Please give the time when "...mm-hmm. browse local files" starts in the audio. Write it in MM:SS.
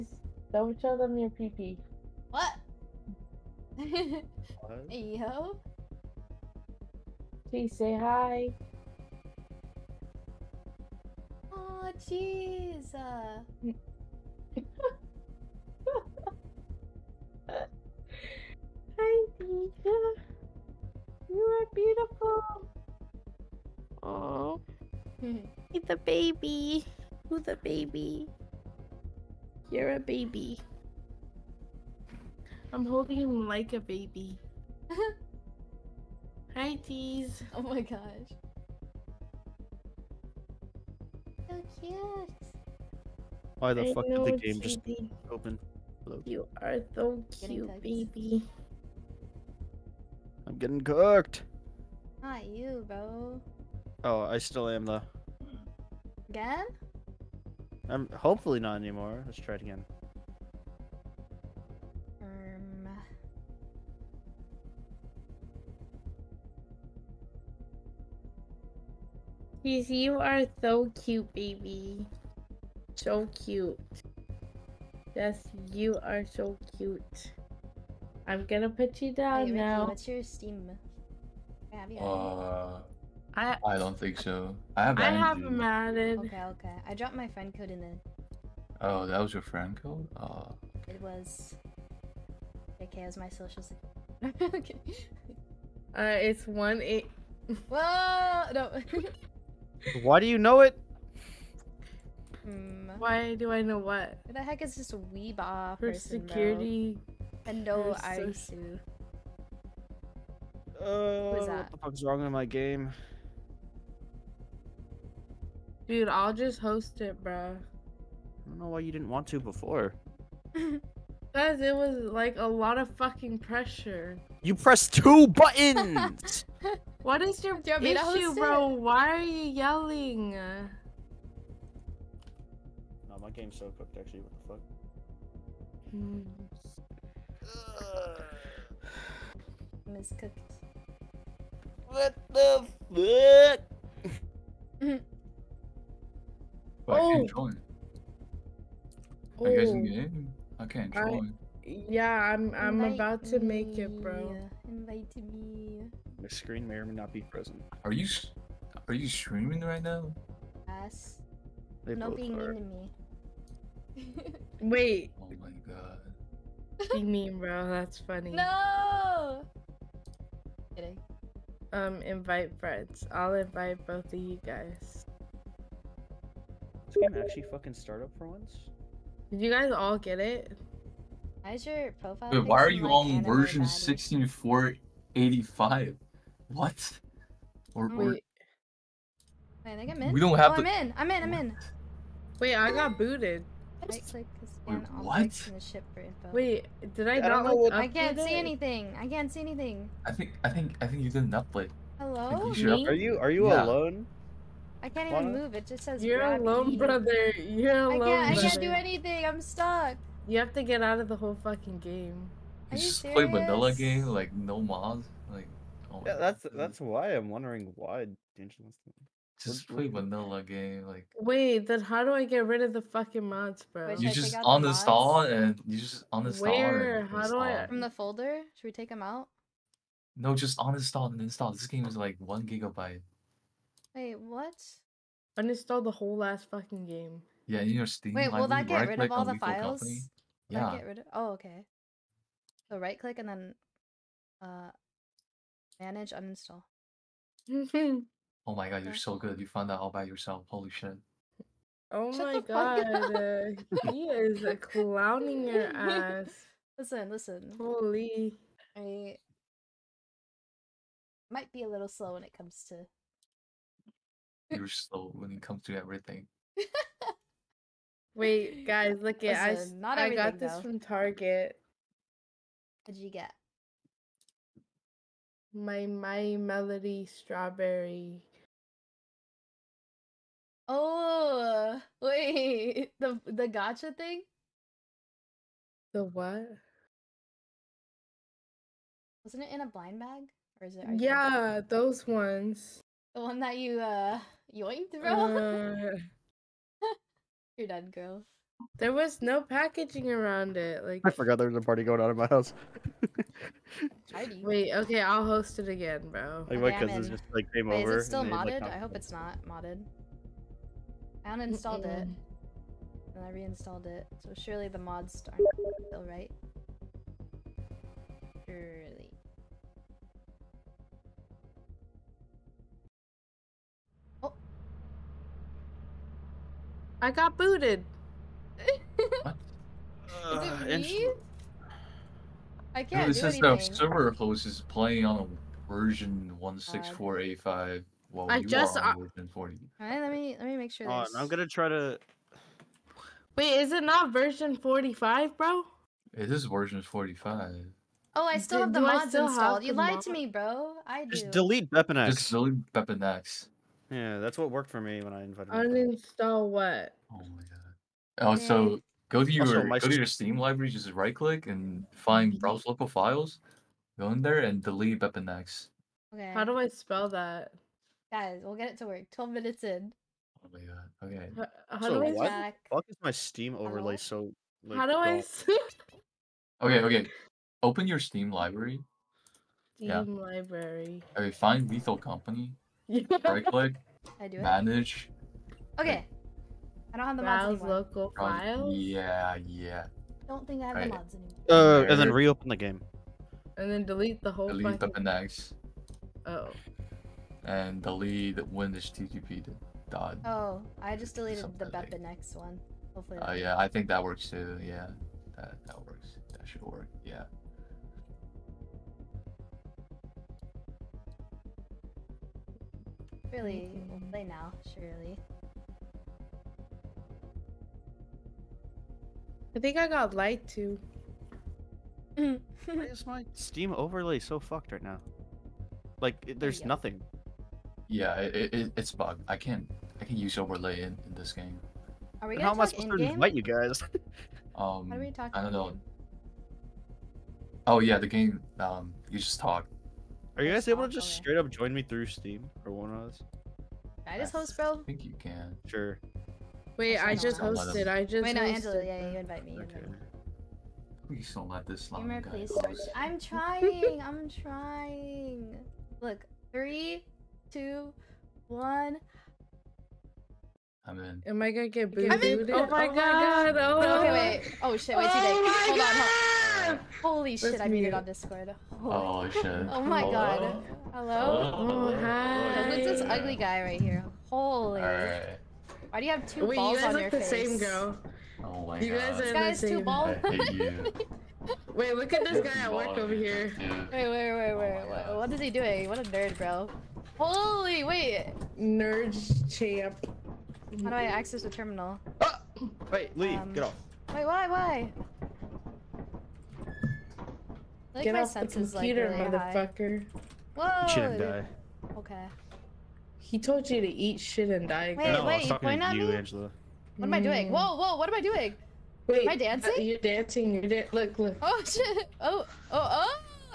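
06:02.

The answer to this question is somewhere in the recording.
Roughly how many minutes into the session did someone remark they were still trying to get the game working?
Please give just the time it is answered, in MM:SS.
06:09.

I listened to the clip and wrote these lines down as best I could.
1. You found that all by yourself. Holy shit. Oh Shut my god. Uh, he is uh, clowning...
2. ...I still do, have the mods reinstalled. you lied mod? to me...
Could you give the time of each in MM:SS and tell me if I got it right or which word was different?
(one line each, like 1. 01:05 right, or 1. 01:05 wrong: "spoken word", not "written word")
1. 04:09 right
2. 05:48 wrong: "installed", not "reinstalled".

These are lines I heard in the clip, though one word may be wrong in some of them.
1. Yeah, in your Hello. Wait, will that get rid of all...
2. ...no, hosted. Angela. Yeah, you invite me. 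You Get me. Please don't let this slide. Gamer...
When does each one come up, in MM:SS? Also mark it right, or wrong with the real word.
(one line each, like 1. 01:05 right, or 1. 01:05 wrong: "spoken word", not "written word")
1. 03:57 wrong: "Steam", not "Hello"
2. 07:28 wrong: "Invite", not "Get".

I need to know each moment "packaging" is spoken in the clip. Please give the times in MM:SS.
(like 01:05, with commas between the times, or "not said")
04:59.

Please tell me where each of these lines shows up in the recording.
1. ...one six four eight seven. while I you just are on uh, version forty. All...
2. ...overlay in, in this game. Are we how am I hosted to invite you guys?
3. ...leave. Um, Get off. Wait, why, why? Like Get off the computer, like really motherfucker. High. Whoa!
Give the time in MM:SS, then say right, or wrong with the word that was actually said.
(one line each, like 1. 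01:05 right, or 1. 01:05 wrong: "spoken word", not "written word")
1. 05:36 wrong: "five", not "seven"
2. 07:10 wrong: "supposed", not "hosted"
3. 08:13 right.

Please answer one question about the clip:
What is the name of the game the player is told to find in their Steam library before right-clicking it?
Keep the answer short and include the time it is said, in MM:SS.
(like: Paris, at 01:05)
Lethal Company, at 06:21.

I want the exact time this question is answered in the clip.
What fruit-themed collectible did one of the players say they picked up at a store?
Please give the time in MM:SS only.
04:35.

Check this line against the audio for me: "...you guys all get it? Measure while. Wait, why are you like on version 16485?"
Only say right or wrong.
wrong.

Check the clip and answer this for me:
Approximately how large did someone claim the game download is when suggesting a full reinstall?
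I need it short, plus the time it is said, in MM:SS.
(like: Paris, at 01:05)
1 gigabyte, at 03:52.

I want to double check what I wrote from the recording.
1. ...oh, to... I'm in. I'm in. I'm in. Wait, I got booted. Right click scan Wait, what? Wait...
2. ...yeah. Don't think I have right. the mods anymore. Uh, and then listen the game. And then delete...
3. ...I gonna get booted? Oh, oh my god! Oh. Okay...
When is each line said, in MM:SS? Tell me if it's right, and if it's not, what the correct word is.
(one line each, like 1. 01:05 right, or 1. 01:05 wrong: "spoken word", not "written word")
1. 03:10 right
2. 06:29 wrong: "reopen", not "listen"
3. 07:41 right.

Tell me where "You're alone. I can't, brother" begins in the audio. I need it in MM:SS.
03:27.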